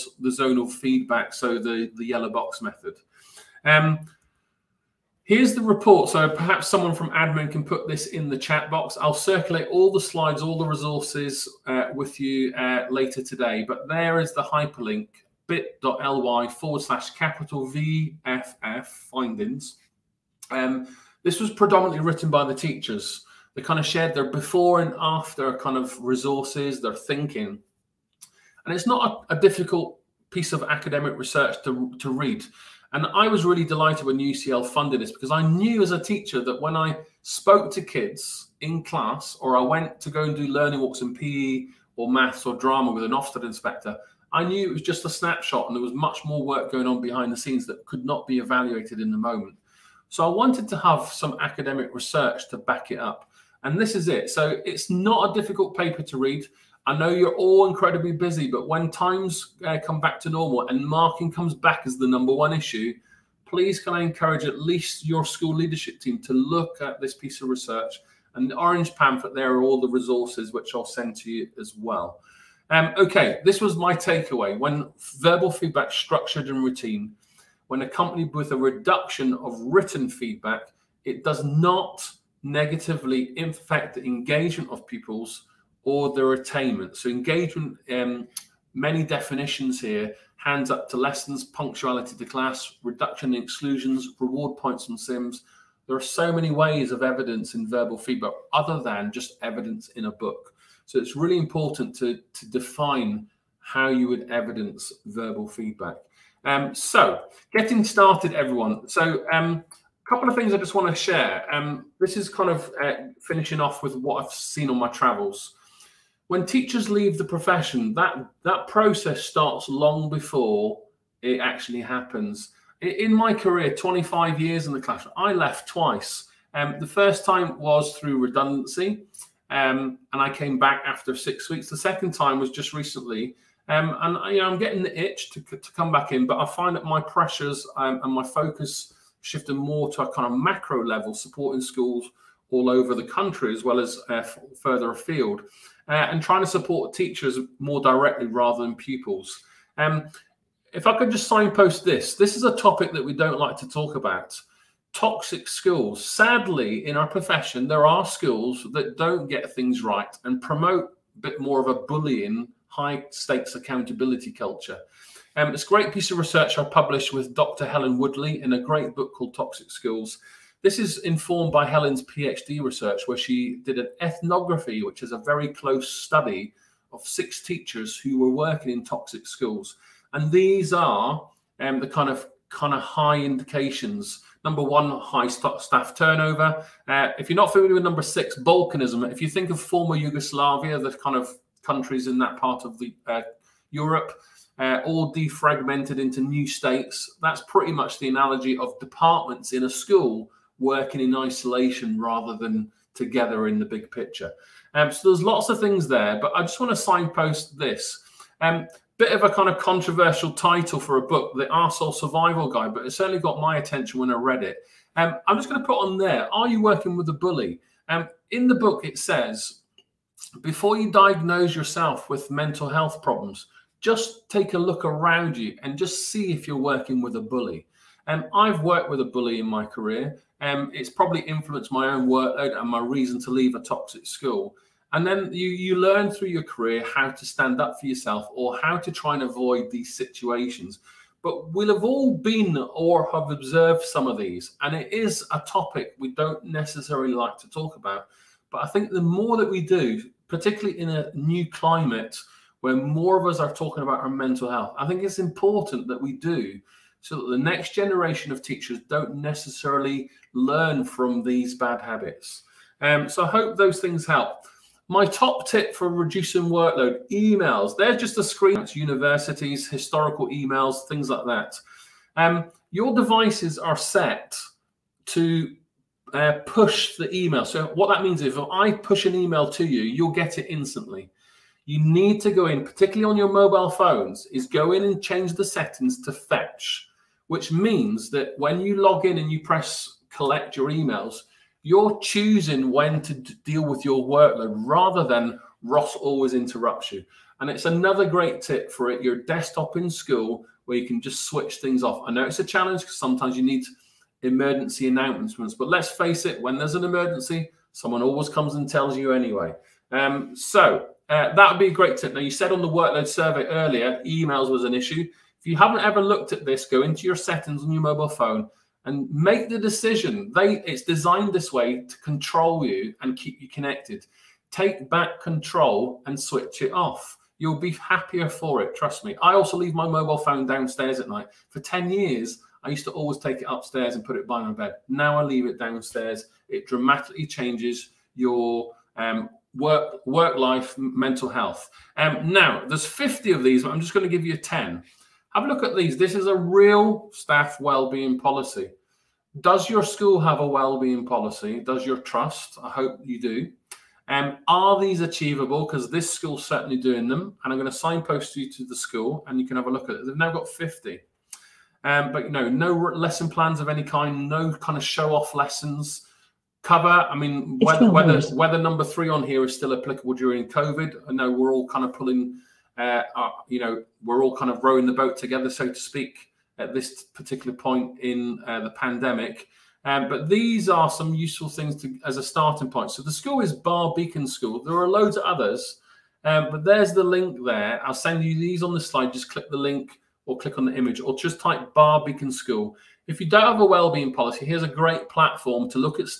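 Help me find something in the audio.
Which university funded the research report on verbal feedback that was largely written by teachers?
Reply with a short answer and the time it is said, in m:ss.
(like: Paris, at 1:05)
UCL, at 0:34.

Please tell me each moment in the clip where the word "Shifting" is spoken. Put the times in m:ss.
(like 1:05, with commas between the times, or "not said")
2:19.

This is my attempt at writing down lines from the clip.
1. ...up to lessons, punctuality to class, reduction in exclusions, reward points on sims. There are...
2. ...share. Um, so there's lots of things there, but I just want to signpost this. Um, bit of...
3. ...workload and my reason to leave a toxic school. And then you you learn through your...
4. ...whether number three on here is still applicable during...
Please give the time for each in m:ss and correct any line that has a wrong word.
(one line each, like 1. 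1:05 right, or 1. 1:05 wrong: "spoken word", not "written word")
1. 1:30 right
2. 3:23 wrong: "picture", not "share"
3. 3:52 right
4. 6:08 right.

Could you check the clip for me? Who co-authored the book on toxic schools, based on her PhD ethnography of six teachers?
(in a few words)
Dr. Helen Woodley.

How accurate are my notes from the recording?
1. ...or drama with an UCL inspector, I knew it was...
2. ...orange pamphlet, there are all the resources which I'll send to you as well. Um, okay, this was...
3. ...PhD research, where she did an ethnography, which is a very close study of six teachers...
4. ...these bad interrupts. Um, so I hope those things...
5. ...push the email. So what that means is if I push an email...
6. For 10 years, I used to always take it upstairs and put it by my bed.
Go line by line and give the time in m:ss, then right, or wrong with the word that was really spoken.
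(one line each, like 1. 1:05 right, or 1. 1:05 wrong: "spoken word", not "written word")
1. 0:42 wrong: "Ofsted", not "UCL"
2. 1:08 right
3. 2:52 right
4. 4:21 wrong: "habits", not "interrupts"
5. 4:36 right
6. 5:31 right.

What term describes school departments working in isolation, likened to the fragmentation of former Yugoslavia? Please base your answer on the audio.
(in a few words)
Balkanism.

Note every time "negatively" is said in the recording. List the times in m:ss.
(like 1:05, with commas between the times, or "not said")
1:22.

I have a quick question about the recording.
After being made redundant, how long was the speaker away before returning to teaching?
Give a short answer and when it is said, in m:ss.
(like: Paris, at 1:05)
6 weeks, at 2:11.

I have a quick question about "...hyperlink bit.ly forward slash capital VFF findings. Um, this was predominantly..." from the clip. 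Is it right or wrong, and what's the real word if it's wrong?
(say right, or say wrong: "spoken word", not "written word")
right.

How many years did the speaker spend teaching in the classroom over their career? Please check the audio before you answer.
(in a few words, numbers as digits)
25.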